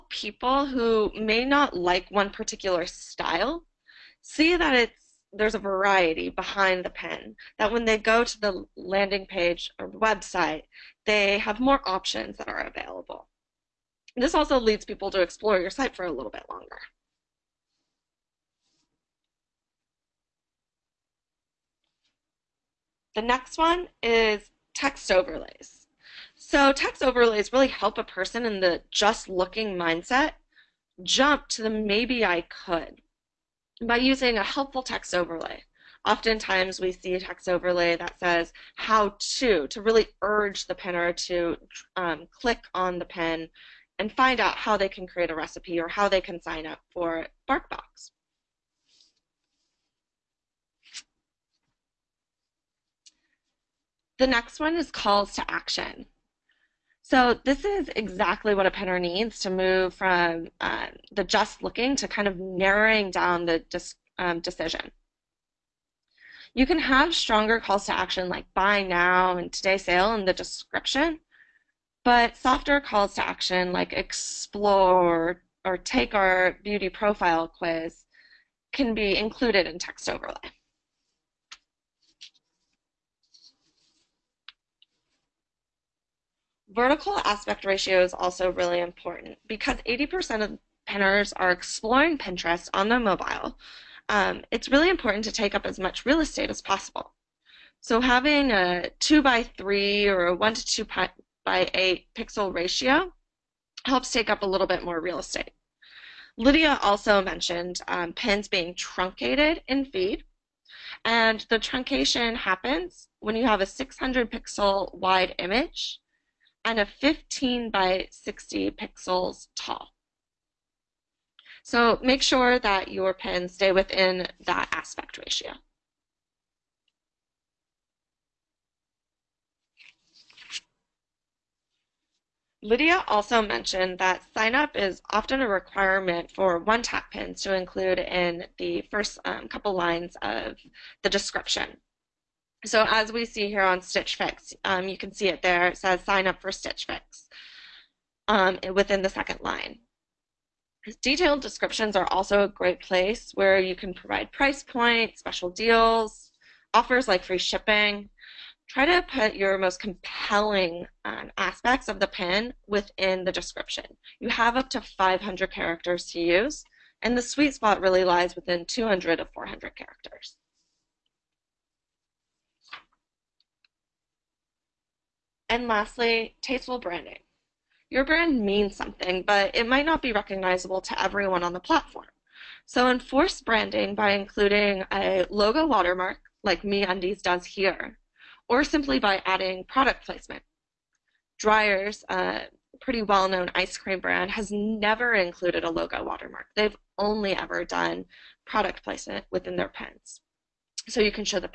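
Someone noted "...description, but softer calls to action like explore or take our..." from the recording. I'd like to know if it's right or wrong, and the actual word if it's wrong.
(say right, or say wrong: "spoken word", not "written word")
right.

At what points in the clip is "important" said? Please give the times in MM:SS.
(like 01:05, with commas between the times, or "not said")
01:28, 01:34.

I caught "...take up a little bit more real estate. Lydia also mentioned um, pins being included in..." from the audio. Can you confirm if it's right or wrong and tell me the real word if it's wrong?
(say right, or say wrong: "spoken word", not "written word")
wrong: "truncated", not "included".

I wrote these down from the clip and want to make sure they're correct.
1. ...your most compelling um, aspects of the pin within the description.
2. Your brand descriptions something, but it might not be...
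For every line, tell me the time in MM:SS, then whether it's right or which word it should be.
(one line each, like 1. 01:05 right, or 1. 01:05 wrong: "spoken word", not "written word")
1. 02:39 right
2. 02:57 wrong: "means", not "descriptions".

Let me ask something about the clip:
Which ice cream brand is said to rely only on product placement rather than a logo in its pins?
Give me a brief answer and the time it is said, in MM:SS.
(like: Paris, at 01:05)
Dreyer's, at 03:11.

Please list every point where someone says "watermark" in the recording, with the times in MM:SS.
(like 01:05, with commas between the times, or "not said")
03:05, 03:16.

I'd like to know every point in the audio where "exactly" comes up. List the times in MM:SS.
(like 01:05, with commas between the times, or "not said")
00:57.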